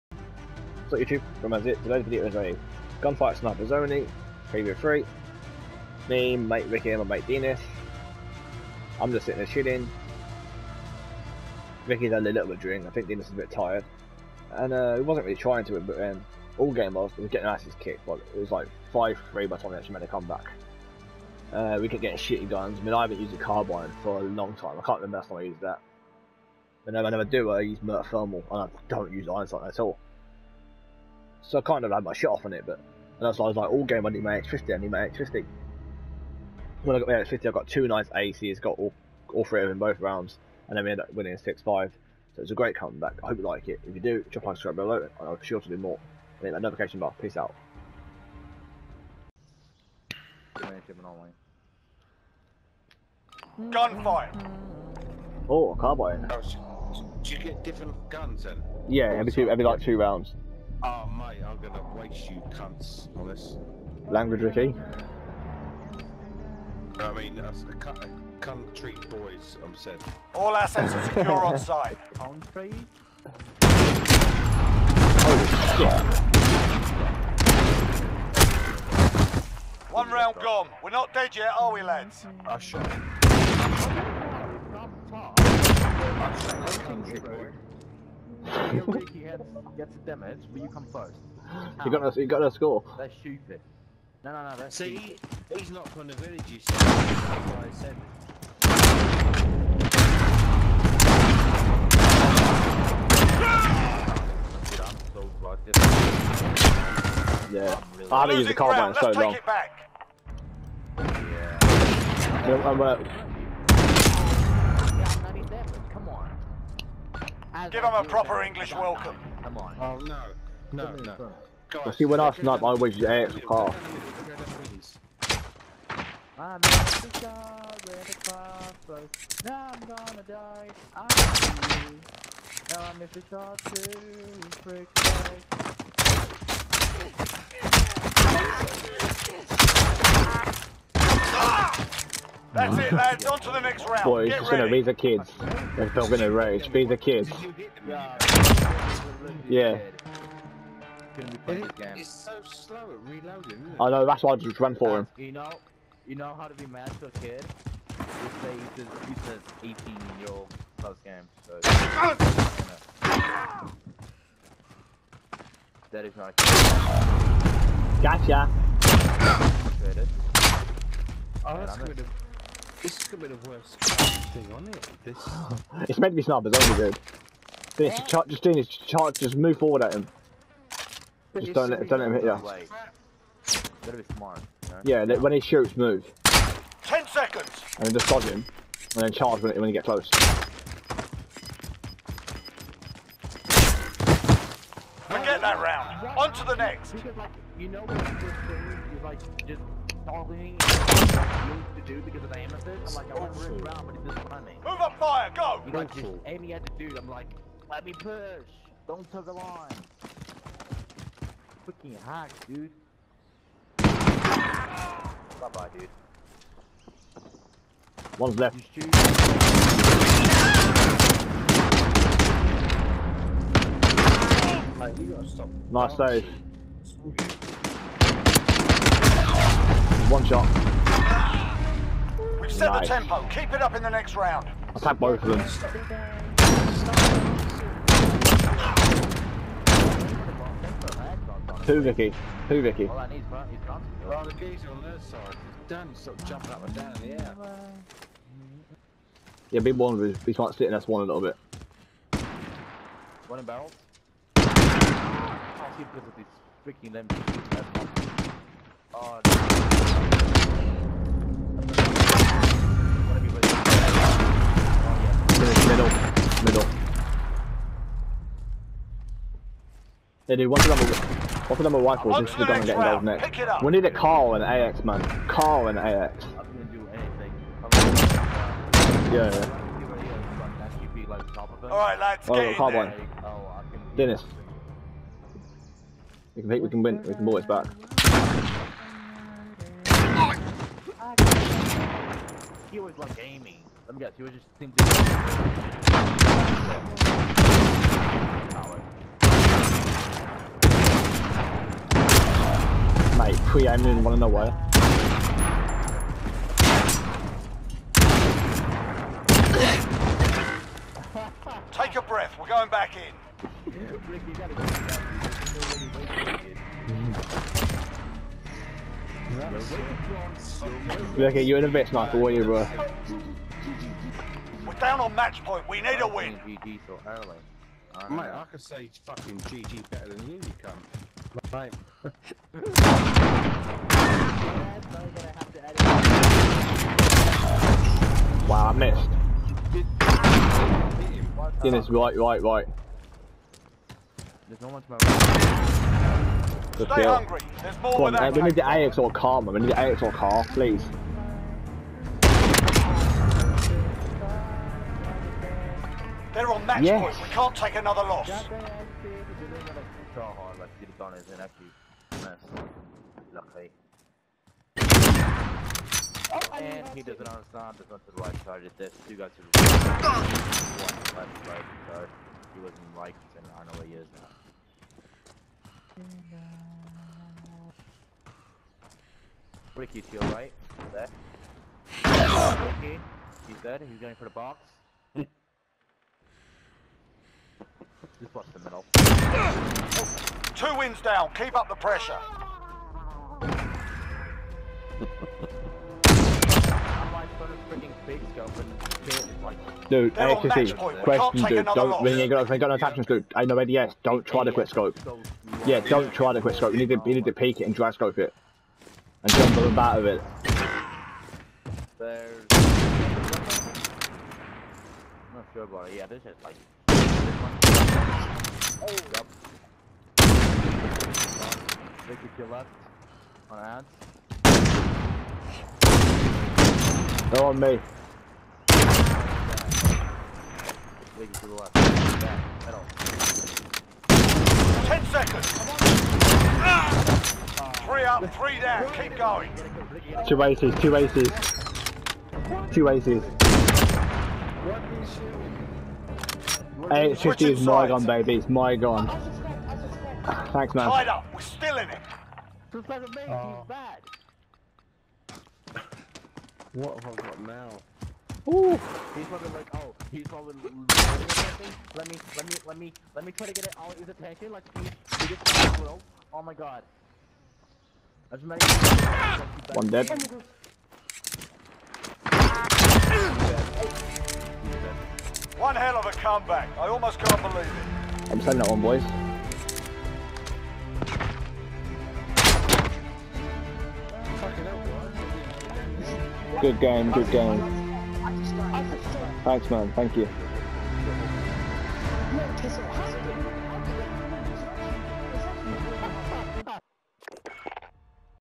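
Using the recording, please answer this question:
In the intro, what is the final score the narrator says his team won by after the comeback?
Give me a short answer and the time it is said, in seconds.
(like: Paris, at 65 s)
6-5, at 41 s.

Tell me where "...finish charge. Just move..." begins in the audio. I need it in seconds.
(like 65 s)
178 s.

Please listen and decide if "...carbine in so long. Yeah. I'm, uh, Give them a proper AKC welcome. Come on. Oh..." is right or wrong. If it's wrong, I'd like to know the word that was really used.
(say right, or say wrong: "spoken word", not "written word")
wrong: "English", not "AKC".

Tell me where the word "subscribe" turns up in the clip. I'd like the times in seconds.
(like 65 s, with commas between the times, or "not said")
44 s.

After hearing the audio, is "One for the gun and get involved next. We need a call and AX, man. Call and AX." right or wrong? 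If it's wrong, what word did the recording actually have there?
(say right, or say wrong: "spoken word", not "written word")
right.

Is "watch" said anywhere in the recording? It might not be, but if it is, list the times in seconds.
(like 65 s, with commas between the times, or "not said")
388 s.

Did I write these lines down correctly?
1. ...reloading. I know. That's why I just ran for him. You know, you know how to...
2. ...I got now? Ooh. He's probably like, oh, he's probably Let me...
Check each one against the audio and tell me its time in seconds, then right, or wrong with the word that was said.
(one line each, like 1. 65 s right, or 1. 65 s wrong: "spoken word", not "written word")
1. 153 s right
2. 457 s right.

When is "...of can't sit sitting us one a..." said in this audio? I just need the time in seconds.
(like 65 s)
249 s.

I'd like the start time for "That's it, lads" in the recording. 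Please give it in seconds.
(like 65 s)
142 s.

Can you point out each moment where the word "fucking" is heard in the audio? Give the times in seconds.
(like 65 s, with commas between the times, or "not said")
211 s, 329 s.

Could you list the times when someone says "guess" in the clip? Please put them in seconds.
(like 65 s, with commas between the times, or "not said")
293 s.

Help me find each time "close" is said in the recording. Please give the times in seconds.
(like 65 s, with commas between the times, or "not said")
160 s, 189 s.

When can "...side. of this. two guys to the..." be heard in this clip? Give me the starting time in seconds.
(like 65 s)
368 s.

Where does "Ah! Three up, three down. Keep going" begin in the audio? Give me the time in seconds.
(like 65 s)
436 s.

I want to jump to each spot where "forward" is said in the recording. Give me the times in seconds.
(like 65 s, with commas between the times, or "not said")
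179 s.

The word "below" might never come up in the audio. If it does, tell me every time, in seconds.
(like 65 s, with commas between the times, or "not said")
44 s.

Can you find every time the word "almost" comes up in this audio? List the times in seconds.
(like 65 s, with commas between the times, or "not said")
476 s.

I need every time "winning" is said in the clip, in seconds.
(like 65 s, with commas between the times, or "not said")
41 s.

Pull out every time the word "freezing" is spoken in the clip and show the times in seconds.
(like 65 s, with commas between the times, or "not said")
not said.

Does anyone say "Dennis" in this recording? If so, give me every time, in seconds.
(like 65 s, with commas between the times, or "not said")
283 s, 341 s.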